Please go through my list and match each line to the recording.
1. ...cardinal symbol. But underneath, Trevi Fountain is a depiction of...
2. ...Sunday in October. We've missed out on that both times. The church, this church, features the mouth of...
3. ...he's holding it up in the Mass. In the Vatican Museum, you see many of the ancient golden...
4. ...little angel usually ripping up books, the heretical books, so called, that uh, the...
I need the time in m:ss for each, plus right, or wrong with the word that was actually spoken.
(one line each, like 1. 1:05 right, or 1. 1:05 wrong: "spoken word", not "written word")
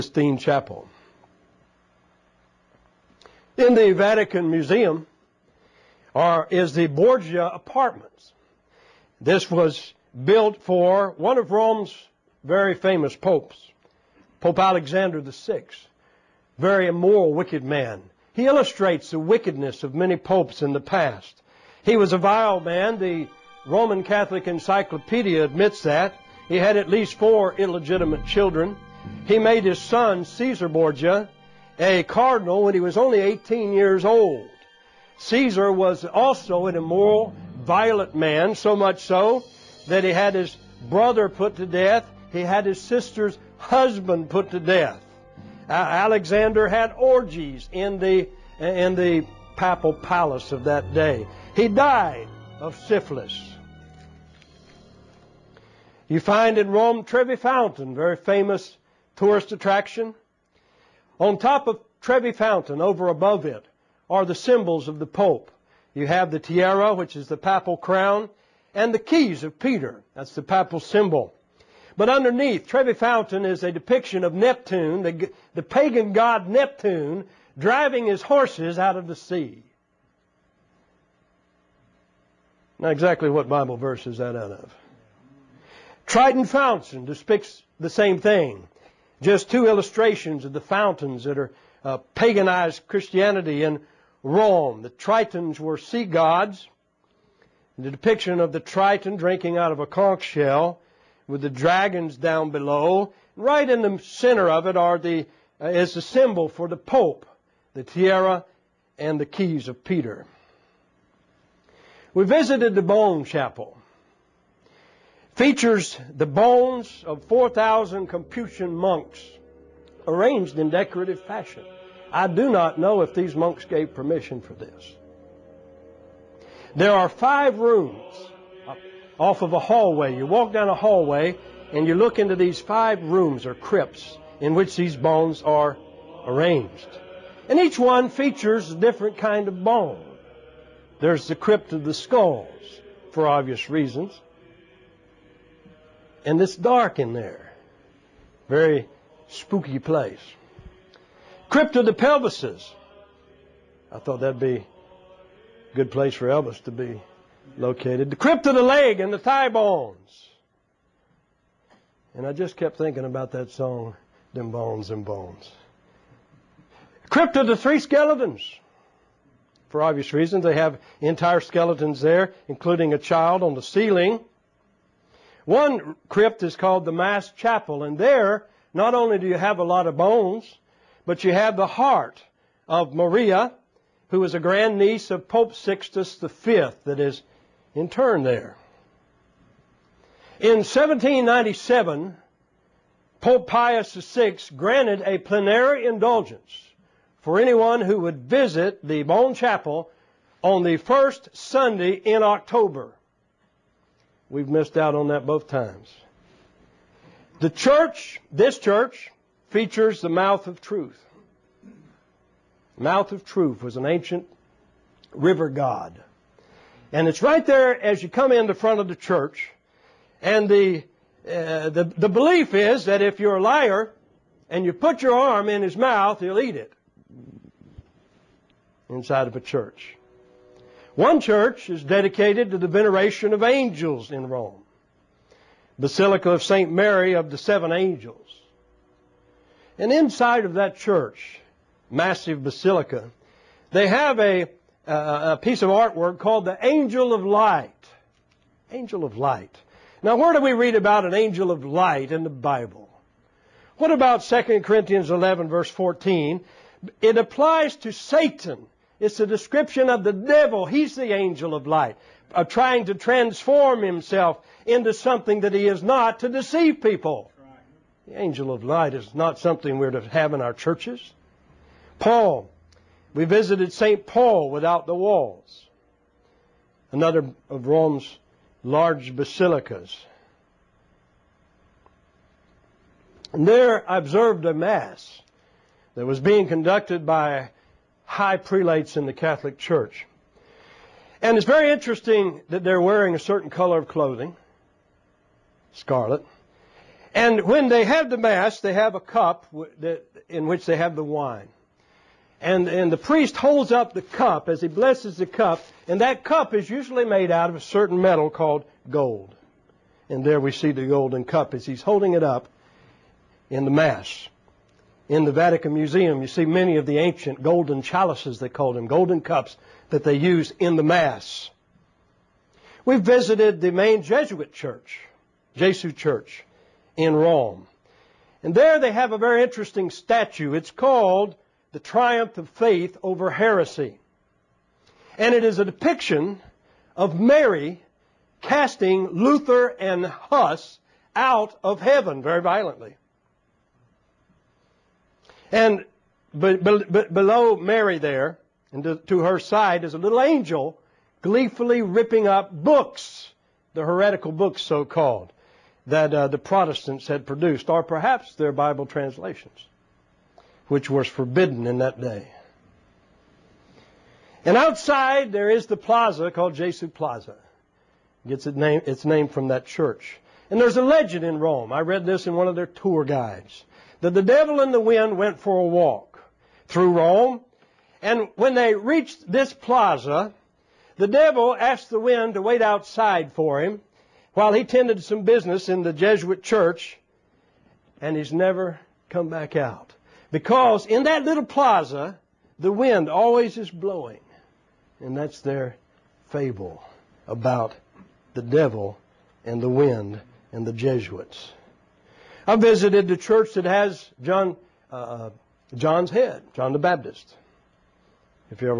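1. 1:10 wrong: "papal", not "cardinal"
2. 3:21 right
3. 5:11 right
4. 5:49 wrong: "gleefully", not "usually".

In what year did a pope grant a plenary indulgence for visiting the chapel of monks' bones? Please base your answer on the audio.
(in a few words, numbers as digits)
1797.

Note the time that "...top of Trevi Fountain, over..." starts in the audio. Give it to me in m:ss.
1:01.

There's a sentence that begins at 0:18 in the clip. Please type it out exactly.
He illustrates the wickedness of many popes in the past.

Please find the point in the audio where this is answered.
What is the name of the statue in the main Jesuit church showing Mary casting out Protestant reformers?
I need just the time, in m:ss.
5:31.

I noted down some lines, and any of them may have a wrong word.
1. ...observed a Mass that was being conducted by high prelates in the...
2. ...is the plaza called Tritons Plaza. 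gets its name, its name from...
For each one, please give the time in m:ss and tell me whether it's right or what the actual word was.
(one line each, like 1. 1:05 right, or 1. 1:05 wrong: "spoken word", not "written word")
1. 4:43 right
2. 6:05 wrong: "Jesu", not "Tritons".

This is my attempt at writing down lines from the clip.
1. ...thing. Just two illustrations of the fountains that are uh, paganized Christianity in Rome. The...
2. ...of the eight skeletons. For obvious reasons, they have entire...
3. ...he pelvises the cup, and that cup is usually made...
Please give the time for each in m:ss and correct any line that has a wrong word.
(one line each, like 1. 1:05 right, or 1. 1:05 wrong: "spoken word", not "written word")
1. 1:28 right
2. 2:47 wrong: "three", not "eight"
3. 5:04 wrong: "blesses", not "pelvises".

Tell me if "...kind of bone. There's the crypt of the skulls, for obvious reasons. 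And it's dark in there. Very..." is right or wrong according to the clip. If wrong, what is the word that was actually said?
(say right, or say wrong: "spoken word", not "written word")
right.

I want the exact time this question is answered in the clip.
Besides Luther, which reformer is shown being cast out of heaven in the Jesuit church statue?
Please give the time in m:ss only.
5:40.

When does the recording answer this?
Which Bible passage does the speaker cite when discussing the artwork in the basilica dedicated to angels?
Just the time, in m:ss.
4:14.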